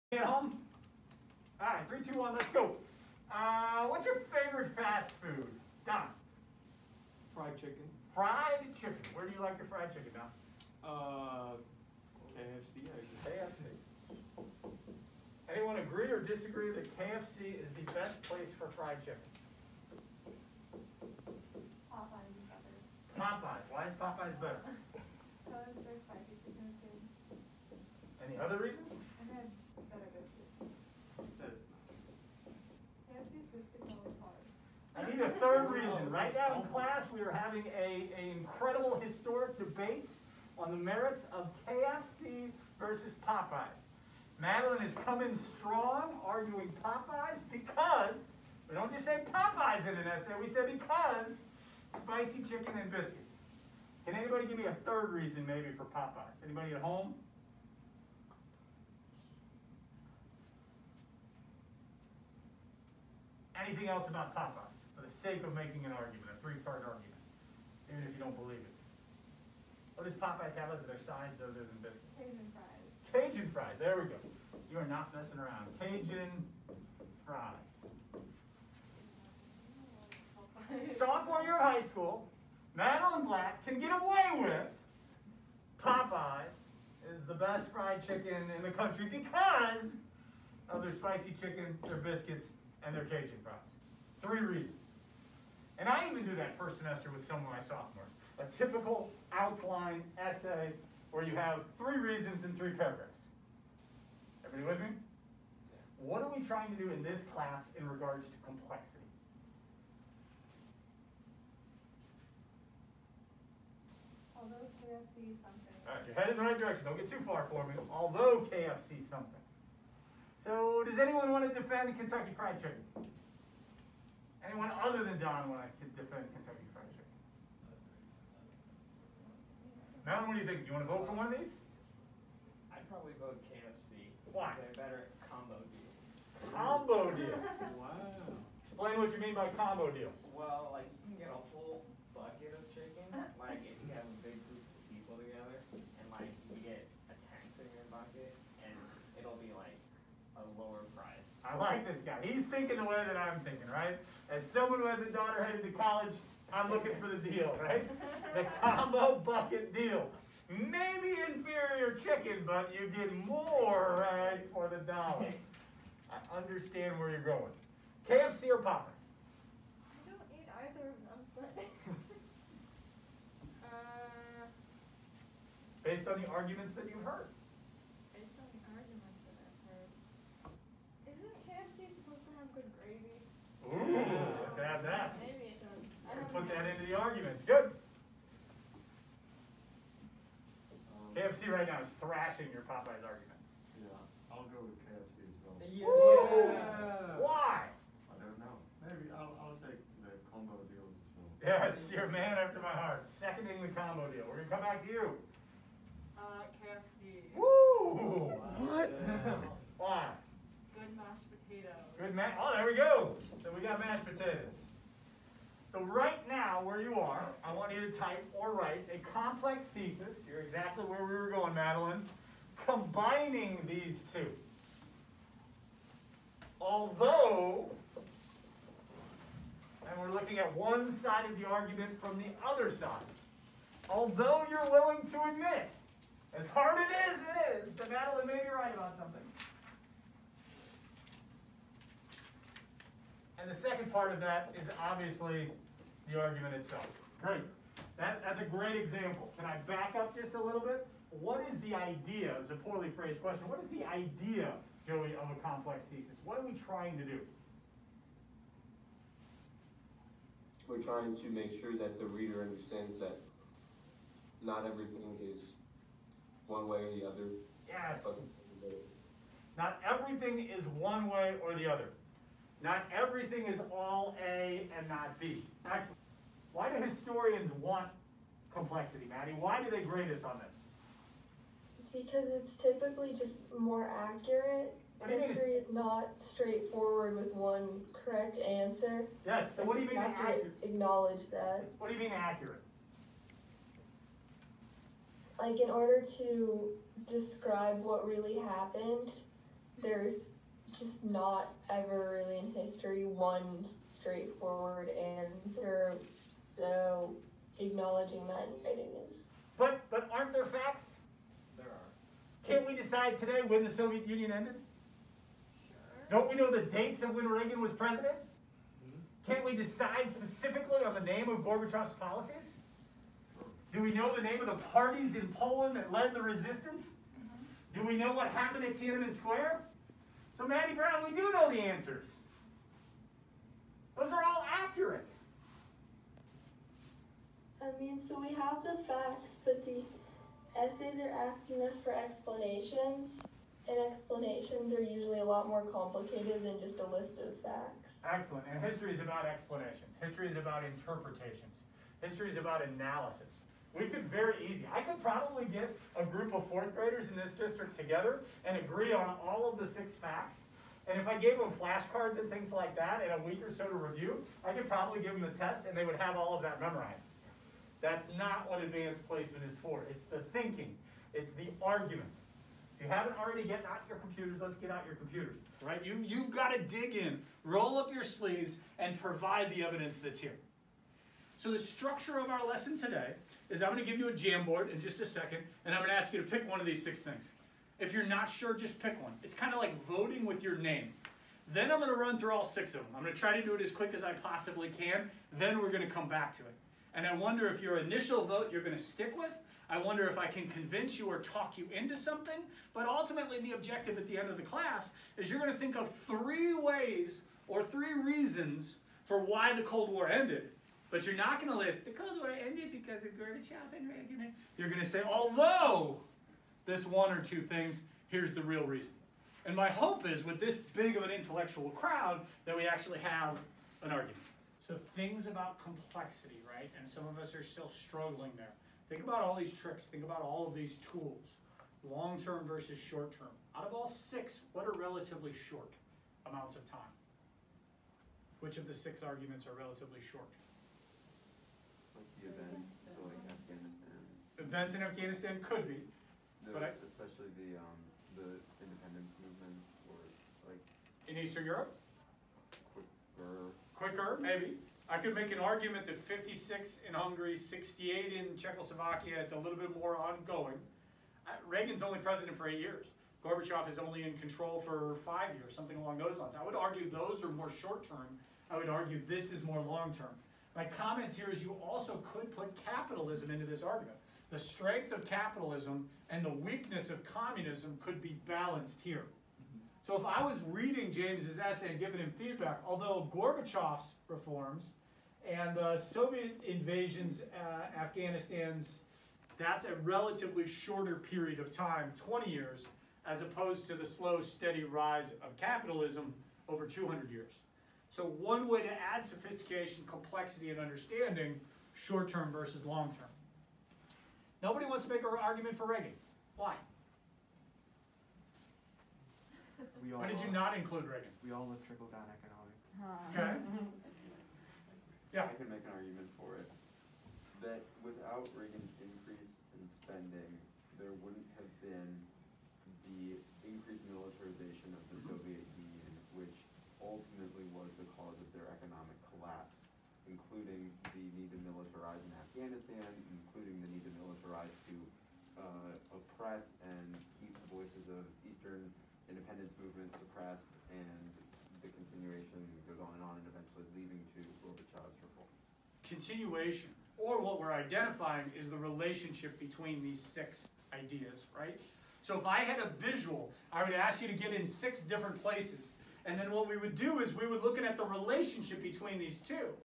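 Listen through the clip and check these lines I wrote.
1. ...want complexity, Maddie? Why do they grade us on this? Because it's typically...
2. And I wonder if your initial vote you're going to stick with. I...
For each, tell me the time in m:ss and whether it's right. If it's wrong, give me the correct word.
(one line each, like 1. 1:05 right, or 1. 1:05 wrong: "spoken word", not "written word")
1. 4:37 right
2. 6:36 right.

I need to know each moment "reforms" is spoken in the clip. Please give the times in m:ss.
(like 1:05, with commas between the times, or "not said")
8:04, 9:04.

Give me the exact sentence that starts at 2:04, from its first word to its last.
Anyone other than Don want to defend Kentucky Fried Chicken?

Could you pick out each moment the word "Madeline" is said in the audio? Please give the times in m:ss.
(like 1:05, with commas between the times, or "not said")
0:44, 1:22, 3:41, 3:57.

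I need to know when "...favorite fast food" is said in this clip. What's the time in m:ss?
0:04.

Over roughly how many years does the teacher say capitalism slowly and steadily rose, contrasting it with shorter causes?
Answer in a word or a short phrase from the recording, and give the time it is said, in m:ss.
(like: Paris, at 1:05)
200 years, at 8:16.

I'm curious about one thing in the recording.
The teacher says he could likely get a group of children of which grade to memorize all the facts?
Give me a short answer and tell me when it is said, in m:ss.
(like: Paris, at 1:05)
Fourth graders, at 5:56.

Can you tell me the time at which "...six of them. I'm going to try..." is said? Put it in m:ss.
6:32.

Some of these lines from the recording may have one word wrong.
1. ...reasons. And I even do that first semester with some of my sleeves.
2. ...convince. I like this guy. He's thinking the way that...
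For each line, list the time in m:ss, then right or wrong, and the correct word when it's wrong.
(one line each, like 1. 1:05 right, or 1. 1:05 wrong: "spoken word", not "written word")
1. 1:34 wrong: "sophomores", not "sleeves"
2. 2:30 wrong: "price", not "convince".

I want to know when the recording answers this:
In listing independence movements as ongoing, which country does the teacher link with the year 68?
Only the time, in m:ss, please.
7:37.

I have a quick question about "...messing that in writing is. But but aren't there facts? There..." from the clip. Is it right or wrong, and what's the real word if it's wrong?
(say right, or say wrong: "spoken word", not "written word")
wrong: "acknowledging", not "messing".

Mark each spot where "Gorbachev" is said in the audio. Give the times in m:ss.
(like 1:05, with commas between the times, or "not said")
5:21, 6:53, 7:43, 8:03, 9:04.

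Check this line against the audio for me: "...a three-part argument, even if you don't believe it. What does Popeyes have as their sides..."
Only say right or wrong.
right.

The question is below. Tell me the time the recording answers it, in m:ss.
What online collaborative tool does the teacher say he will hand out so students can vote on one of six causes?
6:24.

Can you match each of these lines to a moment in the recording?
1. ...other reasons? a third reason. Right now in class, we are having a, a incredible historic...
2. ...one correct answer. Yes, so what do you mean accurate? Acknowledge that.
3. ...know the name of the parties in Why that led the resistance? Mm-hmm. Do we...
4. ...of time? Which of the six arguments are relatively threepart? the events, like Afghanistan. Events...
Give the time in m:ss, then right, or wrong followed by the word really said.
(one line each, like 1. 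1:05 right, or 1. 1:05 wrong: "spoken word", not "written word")
1. 0:28 right
2. 4:47 right
3. 5:23 wrong: "Poland", not "Why"
4. 7:16 wrong: "short", not "threepart".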